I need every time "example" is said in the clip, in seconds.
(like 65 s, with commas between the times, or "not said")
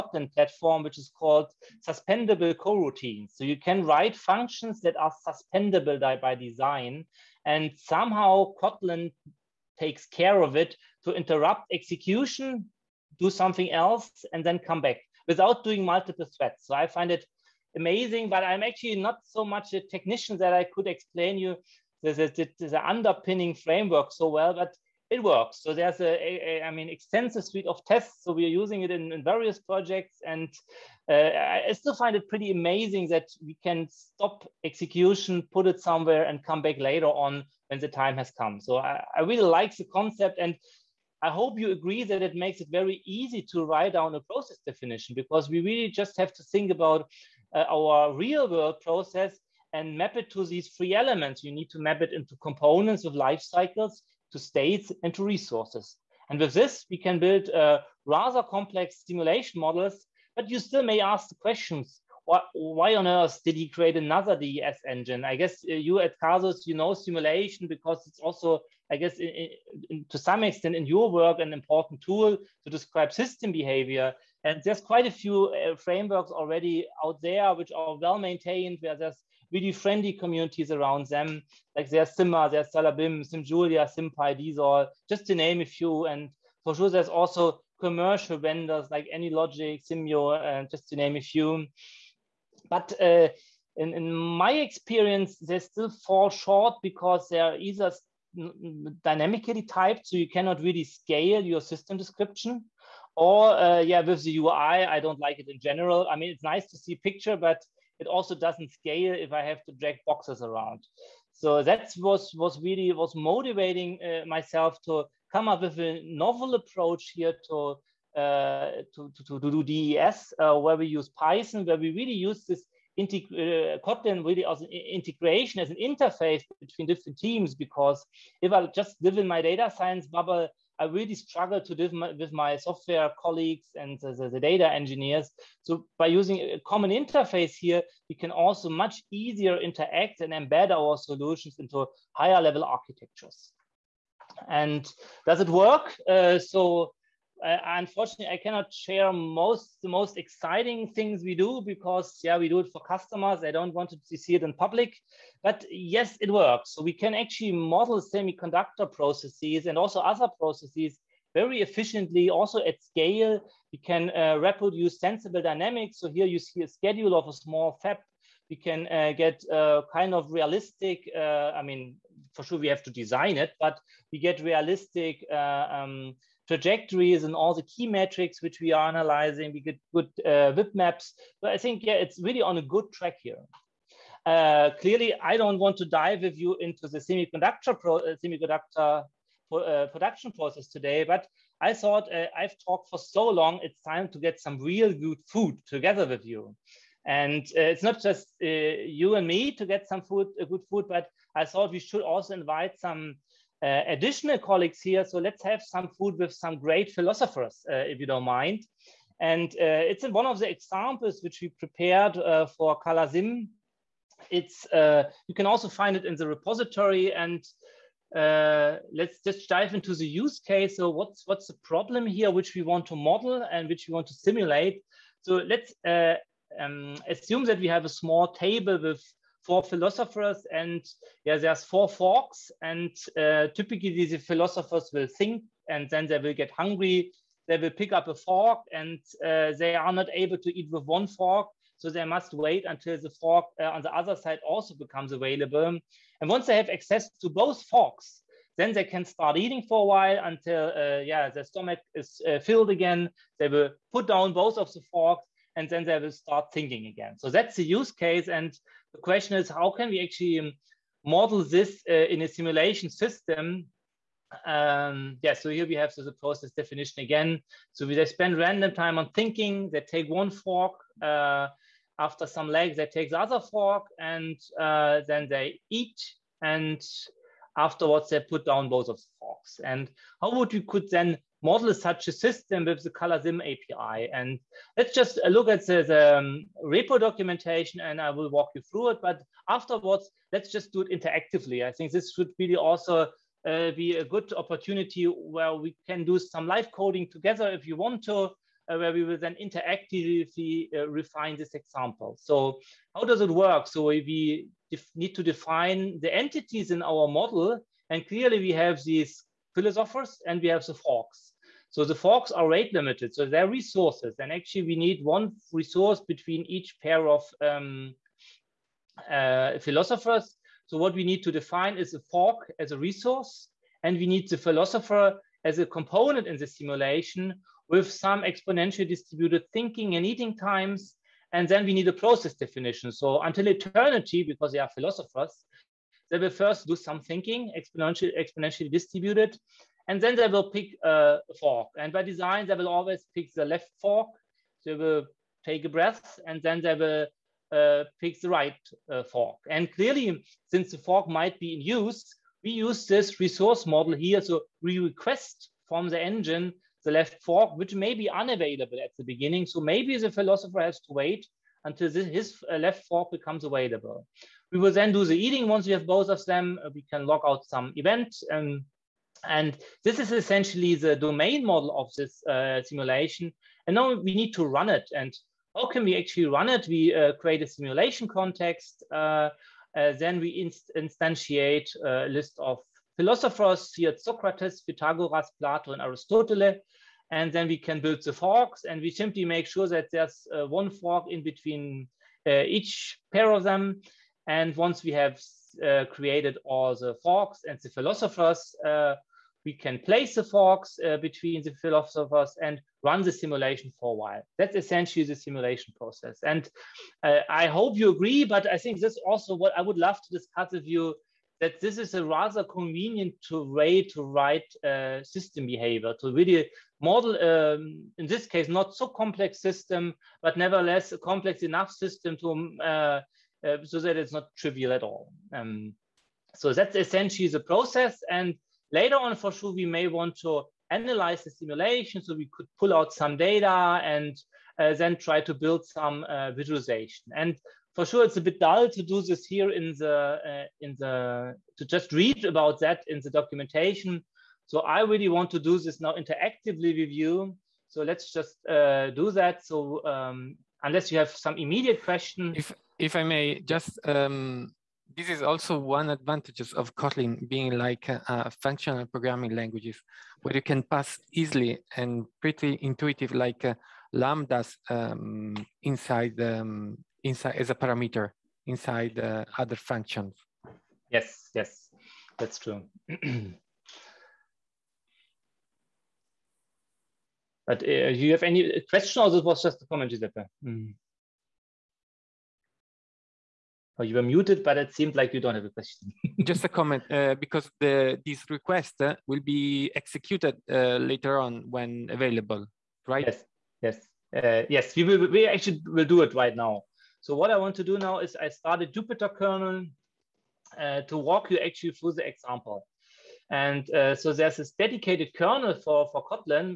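210 s, 301 s, 502 s.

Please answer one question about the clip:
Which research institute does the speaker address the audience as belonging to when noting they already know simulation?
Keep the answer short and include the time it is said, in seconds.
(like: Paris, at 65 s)
CASUS, at 66 s.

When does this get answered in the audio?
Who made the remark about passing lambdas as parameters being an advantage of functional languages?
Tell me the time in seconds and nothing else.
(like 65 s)
479 s.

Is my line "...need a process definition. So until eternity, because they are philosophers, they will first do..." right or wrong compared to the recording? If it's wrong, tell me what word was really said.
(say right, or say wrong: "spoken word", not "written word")
right.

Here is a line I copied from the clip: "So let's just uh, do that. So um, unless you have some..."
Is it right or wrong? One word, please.
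right.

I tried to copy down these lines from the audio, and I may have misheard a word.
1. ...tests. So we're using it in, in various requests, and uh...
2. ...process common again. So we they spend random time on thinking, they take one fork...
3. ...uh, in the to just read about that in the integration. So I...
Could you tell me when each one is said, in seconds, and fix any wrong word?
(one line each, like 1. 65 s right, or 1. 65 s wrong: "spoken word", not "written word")
1. 27 s wrong: "projects", not "requests"
2. 266 s wrong: "definition", not "common"
3. 440 s wrong: "documentation", not "integration".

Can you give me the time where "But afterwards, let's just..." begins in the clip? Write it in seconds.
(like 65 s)
289 s.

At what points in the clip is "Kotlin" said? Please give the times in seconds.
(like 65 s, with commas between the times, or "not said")
8 s, 123 s, 456 s, 506 s.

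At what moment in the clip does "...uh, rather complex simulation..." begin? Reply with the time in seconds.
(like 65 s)
57 s.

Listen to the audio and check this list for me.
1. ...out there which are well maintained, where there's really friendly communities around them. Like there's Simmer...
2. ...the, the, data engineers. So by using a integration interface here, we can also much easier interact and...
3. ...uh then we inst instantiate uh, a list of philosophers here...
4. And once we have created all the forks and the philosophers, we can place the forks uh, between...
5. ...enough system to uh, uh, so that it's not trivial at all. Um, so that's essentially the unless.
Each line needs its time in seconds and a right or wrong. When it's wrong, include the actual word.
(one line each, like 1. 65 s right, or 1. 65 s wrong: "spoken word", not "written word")
1. 77 s right
2. 133 s wrong: "common", not "integration"
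3. 379 s right
4. 394 s right
5. 421 s wrong: "process", not "unless".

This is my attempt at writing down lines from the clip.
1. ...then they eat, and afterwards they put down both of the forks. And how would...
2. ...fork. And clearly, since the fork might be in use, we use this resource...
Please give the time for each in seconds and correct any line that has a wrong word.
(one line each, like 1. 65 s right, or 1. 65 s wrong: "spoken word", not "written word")
1. 275 s right
2. 349 s right.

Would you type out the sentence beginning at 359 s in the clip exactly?
So maybe the philosopher has to wait until this, his uh, left fork becomes available.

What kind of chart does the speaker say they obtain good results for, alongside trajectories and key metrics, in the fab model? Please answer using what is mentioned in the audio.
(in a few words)
WIP maps.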